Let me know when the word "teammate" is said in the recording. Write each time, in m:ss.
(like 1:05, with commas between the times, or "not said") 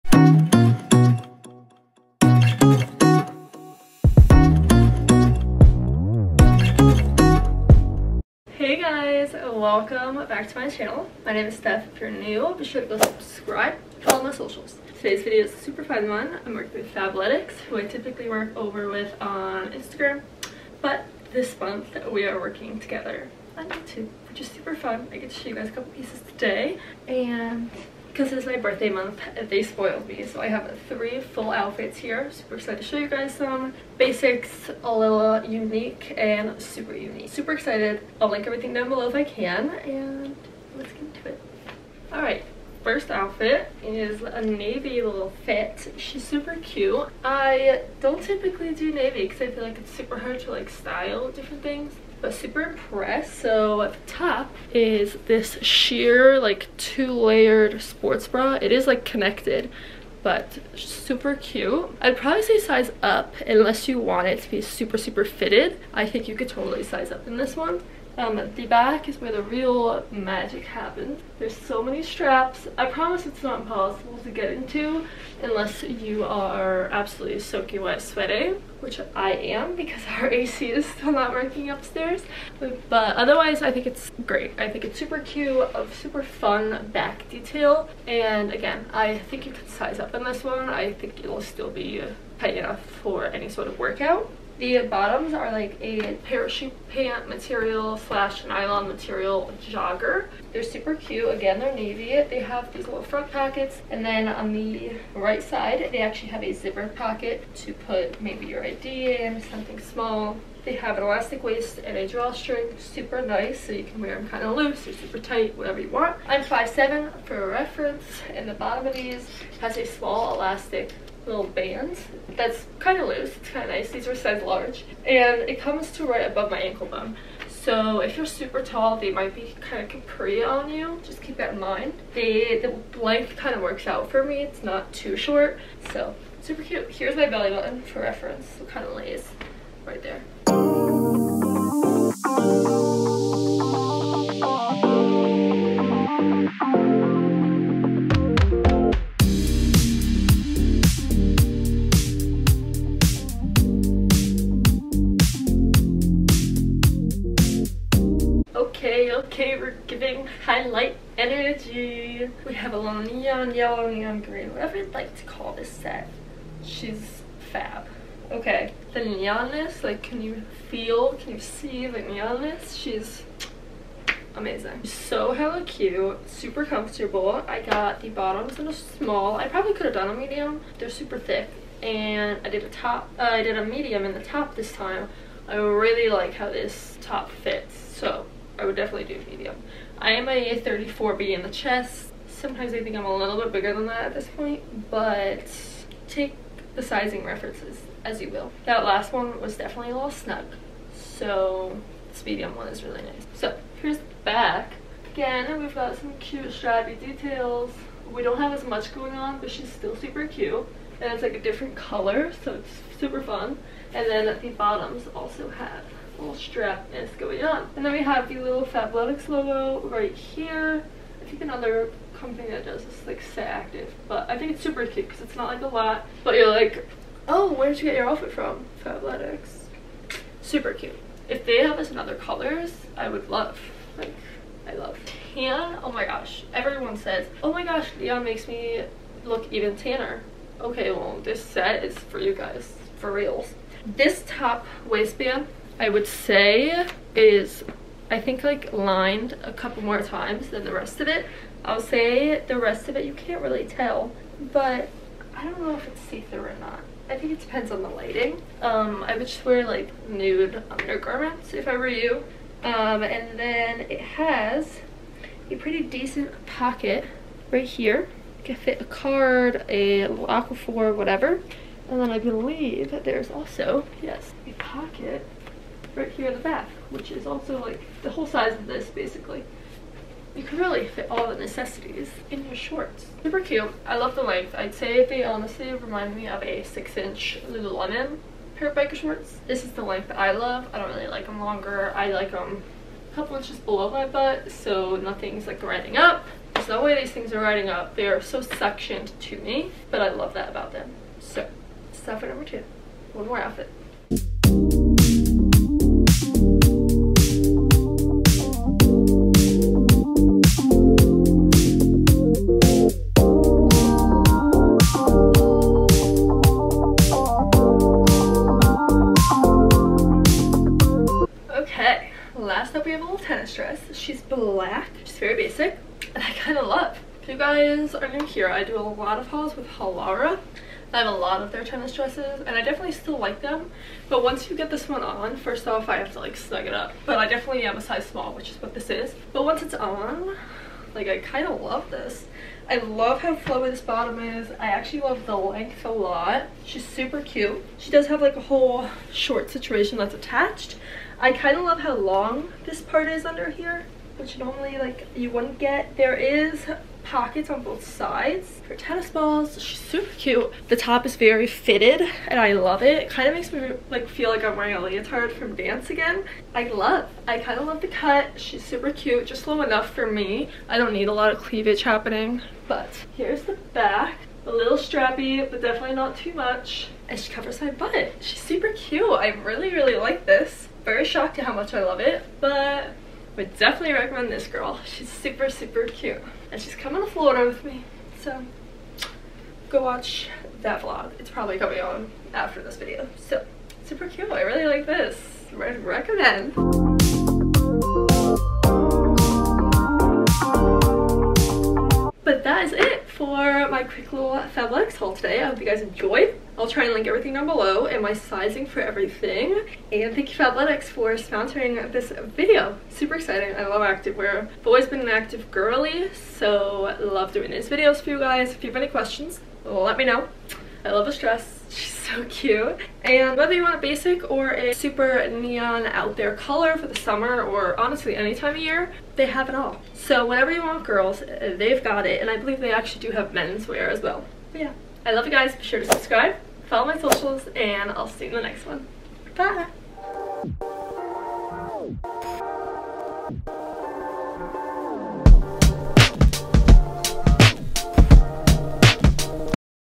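not said.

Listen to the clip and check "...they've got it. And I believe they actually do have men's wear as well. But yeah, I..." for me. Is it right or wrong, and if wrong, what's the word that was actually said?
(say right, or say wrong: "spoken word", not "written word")
right.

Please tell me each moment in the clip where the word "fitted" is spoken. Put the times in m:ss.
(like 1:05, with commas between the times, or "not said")
1:05, 6:01.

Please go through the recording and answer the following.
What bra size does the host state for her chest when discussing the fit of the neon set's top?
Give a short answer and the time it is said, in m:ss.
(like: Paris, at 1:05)
34B, at 3:10.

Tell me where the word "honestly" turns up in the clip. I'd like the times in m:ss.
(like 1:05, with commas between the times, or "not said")
4:45, 7:07.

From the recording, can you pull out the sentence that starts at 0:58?
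It is like connected but super cute.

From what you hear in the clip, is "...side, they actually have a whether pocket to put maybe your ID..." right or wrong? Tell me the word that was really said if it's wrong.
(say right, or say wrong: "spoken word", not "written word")
wrong: "zipper", not "whether".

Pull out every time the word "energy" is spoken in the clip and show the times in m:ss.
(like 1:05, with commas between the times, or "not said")
2:41.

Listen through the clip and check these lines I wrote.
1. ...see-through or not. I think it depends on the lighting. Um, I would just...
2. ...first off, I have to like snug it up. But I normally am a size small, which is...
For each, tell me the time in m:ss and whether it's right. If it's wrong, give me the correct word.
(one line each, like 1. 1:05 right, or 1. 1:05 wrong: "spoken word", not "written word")
1. 4:16 right
2. 5:35 wrong: "definitely", not "normally".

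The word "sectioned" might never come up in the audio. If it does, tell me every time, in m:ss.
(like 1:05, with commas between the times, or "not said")
4:58.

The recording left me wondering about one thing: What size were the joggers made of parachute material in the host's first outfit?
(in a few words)
Large.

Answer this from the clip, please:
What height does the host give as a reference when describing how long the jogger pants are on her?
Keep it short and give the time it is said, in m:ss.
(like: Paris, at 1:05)
5'7", at 1:56.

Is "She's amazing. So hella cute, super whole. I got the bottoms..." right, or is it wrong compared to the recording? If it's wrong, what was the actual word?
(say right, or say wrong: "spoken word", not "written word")
wrong: "comfortable", not "whole".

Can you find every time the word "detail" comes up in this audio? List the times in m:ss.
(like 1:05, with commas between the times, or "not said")
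1:27, 3:26.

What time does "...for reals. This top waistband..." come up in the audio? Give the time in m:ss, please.
4:02.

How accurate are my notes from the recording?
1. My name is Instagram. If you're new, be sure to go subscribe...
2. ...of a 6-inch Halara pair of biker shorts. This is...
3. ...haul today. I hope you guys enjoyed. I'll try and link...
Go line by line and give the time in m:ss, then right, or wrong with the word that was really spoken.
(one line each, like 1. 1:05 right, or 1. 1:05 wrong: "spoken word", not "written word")
1. 0:11 wrong: "Steph", not "Instagram"
2. 4:46 wrong: "Lululemon", not "Halara"
3. 6:44 right.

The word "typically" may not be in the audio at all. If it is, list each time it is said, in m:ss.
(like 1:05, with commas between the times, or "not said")
0:17, 0:48.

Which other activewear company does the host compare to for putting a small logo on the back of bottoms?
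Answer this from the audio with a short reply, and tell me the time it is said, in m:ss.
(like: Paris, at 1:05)
Set Active, at 3:43.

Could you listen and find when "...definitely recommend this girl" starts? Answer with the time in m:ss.
6:23.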